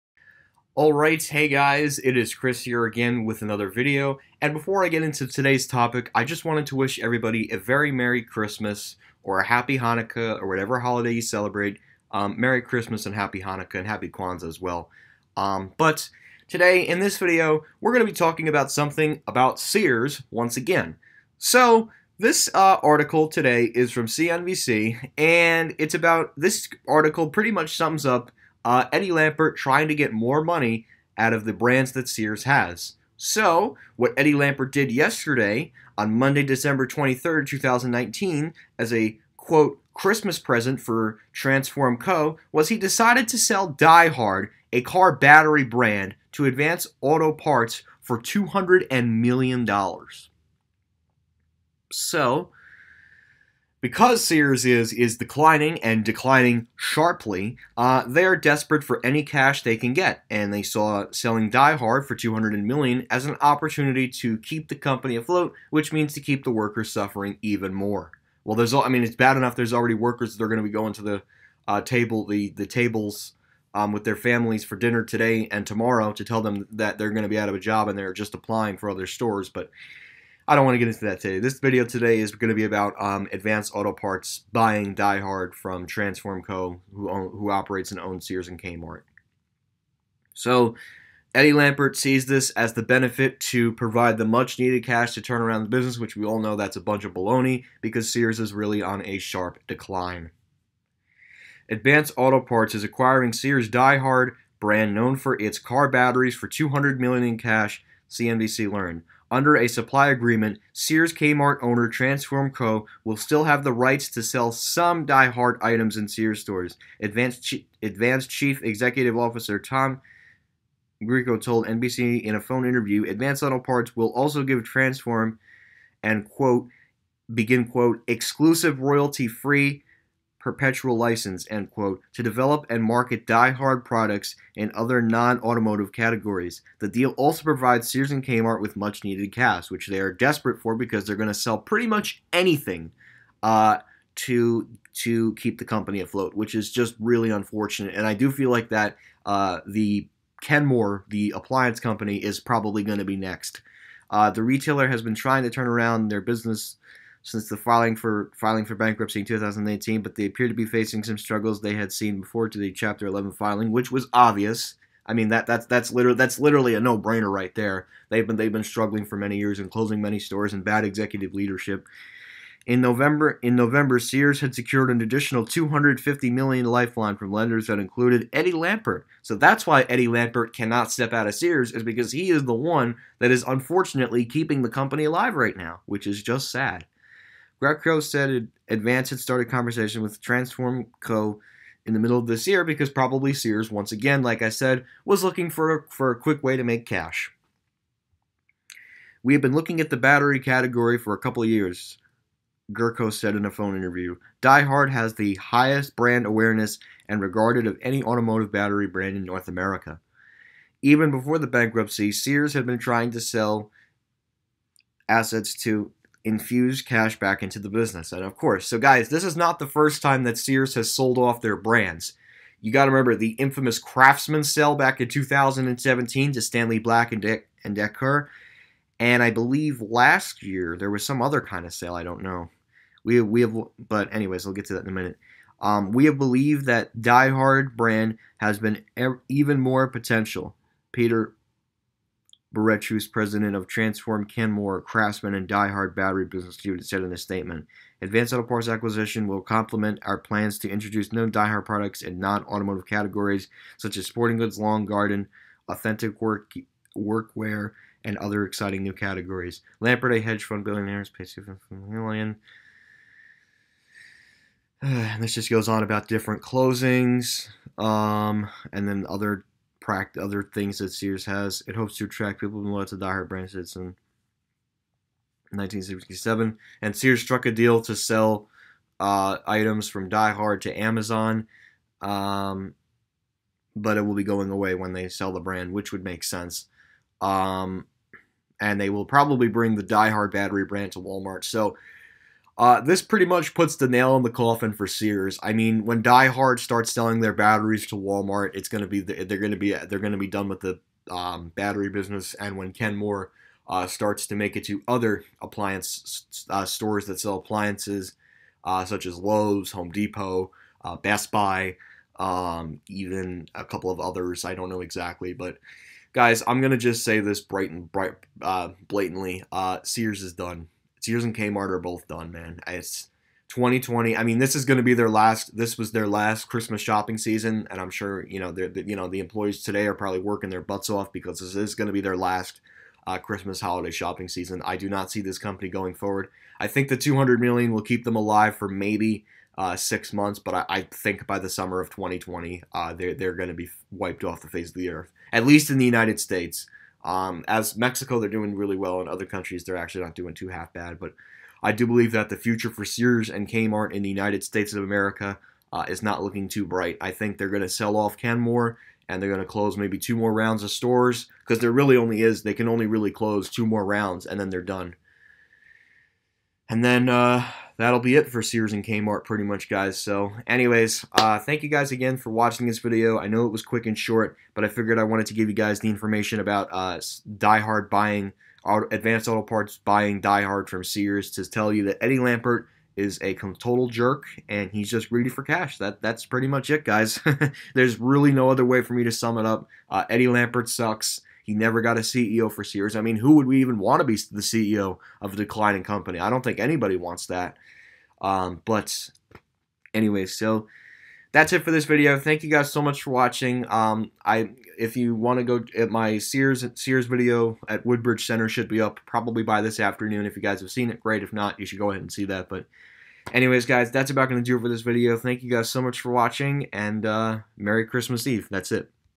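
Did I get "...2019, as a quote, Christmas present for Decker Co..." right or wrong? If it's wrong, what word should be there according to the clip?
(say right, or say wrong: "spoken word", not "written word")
wrong: "Transform", not "Decker".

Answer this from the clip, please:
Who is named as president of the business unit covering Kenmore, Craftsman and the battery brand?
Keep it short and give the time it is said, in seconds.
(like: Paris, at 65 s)
Peter Boutros, at 240 s.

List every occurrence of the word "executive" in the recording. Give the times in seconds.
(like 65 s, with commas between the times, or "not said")
118 s, 170 s.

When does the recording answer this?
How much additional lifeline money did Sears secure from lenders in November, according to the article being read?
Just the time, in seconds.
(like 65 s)
175 s.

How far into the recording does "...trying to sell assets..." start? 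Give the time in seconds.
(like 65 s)
212 s.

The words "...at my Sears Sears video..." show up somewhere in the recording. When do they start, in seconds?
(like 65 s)
405 s.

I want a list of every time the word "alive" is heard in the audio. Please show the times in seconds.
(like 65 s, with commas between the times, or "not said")
185 s, 338 s.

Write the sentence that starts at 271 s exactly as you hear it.
It hopes to attract people loyal to DieHard brand since in 1967.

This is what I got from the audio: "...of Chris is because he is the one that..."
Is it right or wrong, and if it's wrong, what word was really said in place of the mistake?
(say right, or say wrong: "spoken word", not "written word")
wrong: "Sears", not "Chris".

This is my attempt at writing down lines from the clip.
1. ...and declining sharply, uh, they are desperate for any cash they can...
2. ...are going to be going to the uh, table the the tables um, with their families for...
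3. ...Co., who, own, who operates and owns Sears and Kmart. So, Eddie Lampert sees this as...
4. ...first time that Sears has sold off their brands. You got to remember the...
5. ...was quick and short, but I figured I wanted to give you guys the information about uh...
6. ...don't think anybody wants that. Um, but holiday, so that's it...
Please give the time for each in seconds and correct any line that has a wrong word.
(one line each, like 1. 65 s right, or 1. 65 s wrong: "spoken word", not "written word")
1. 55 s right
2. 70 s right
3. 86 s right
4. 219 s right
5. 373 s right
6. 396 s wrong: "anyway", not "holiday".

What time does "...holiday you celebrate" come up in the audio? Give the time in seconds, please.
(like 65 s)
10 s.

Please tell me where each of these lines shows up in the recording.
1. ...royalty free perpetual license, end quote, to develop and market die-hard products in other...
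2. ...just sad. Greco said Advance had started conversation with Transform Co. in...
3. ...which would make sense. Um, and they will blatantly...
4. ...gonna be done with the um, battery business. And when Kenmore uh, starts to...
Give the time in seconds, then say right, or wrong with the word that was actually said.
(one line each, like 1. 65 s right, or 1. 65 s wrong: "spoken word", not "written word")
1. 128 s right
2. 186 s right
3. 285 s wrong: "probably", not "blatantly"
4. 299 s right.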